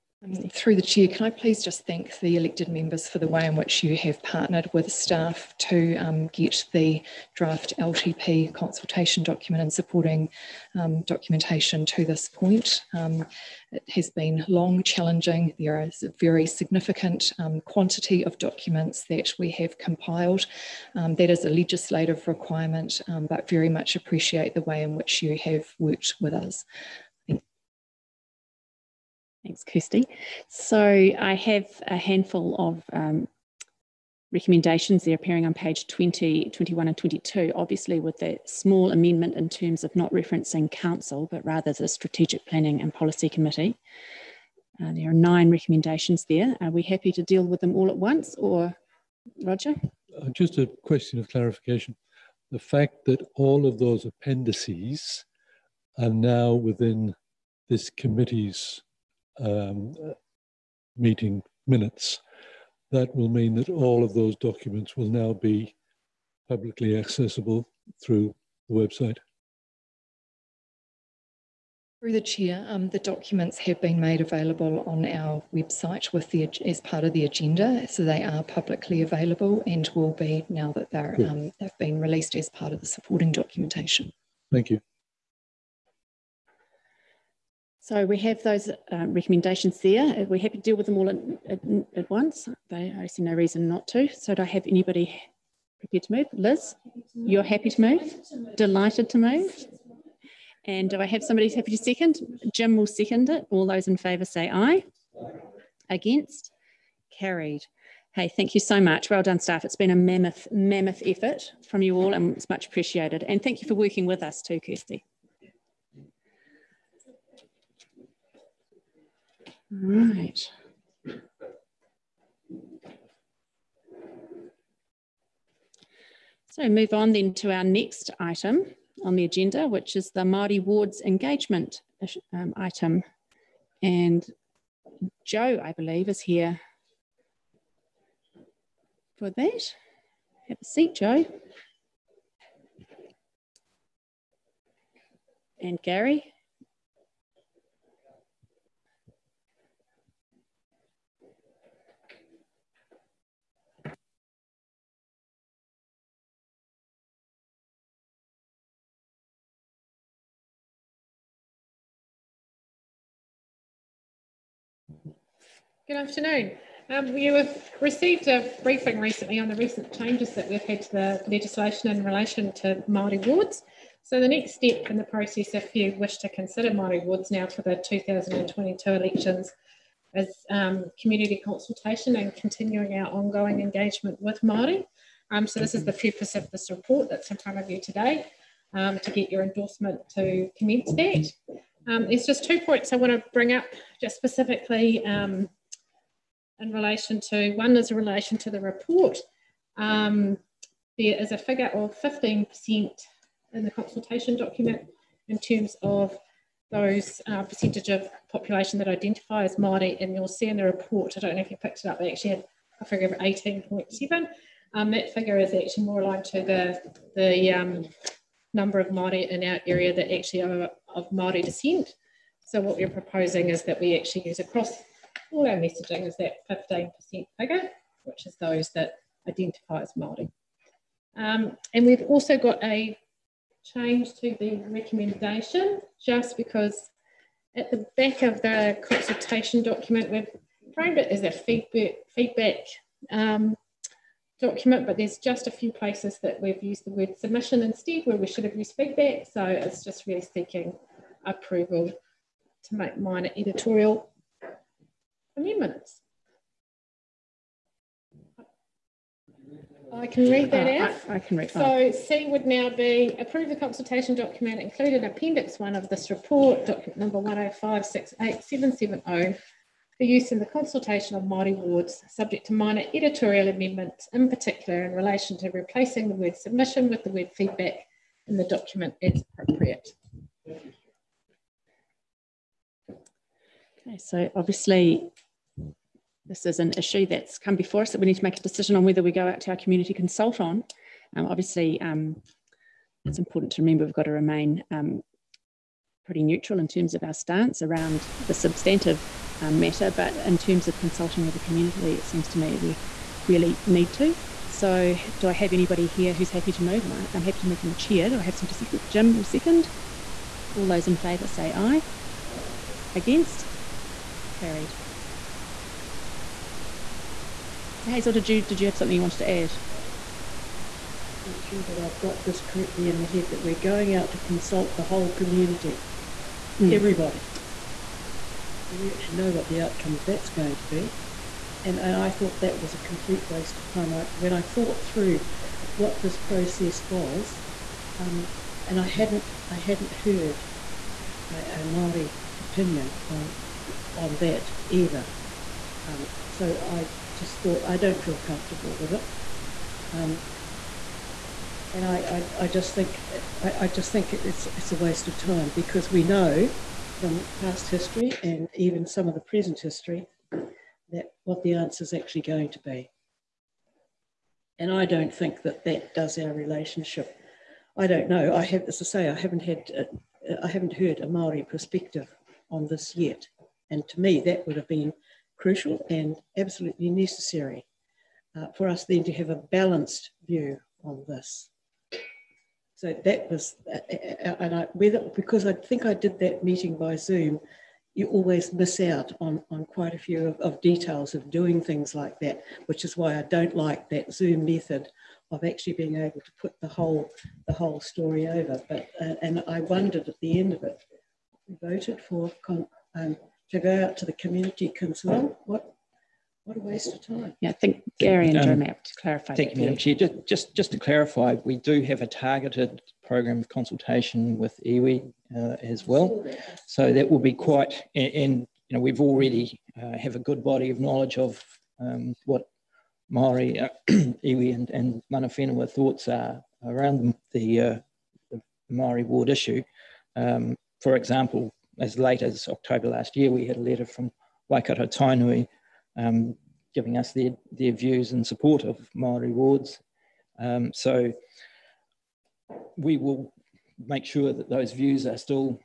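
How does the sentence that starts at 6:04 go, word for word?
And I don't think that that does our relationship.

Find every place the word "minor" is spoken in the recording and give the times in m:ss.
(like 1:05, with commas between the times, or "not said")
4:12, 4:32.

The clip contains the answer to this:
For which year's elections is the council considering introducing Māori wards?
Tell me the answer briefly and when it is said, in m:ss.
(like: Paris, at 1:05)
2022, at 2:57.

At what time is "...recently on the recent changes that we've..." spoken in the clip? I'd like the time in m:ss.
2:48.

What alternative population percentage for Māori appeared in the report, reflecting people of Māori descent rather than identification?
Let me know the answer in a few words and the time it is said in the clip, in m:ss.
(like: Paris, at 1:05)
18.7%, at 3:33.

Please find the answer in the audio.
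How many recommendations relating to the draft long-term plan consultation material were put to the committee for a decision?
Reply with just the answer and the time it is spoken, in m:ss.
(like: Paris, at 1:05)
9, at 0:45.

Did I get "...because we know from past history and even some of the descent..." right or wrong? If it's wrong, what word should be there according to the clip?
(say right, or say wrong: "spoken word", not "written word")
wrong: "present", not "descent".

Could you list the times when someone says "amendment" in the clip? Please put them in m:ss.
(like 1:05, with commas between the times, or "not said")
0:38, 4:33.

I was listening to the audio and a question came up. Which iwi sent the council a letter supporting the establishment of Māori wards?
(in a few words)
Waikato Tainui.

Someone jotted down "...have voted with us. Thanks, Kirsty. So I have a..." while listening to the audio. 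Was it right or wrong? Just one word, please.
wrong.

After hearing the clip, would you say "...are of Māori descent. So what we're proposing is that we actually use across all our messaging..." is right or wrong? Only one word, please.
right.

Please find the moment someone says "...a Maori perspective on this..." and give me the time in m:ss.
6:10.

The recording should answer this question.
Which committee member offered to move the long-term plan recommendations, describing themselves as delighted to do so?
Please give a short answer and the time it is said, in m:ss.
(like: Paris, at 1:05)
Liz, at 1:36.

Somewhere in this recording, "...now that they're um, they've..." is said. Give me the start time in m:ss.
1:20.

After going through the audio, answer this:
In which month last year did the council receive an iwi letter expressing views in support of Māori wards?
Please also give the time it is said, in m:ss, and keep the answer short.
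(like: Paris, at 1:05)
October, at 7:12.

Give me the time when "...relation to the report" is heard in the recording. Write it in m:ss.
3:17.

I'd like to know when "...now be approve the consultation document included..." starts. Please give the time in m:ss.
4:22.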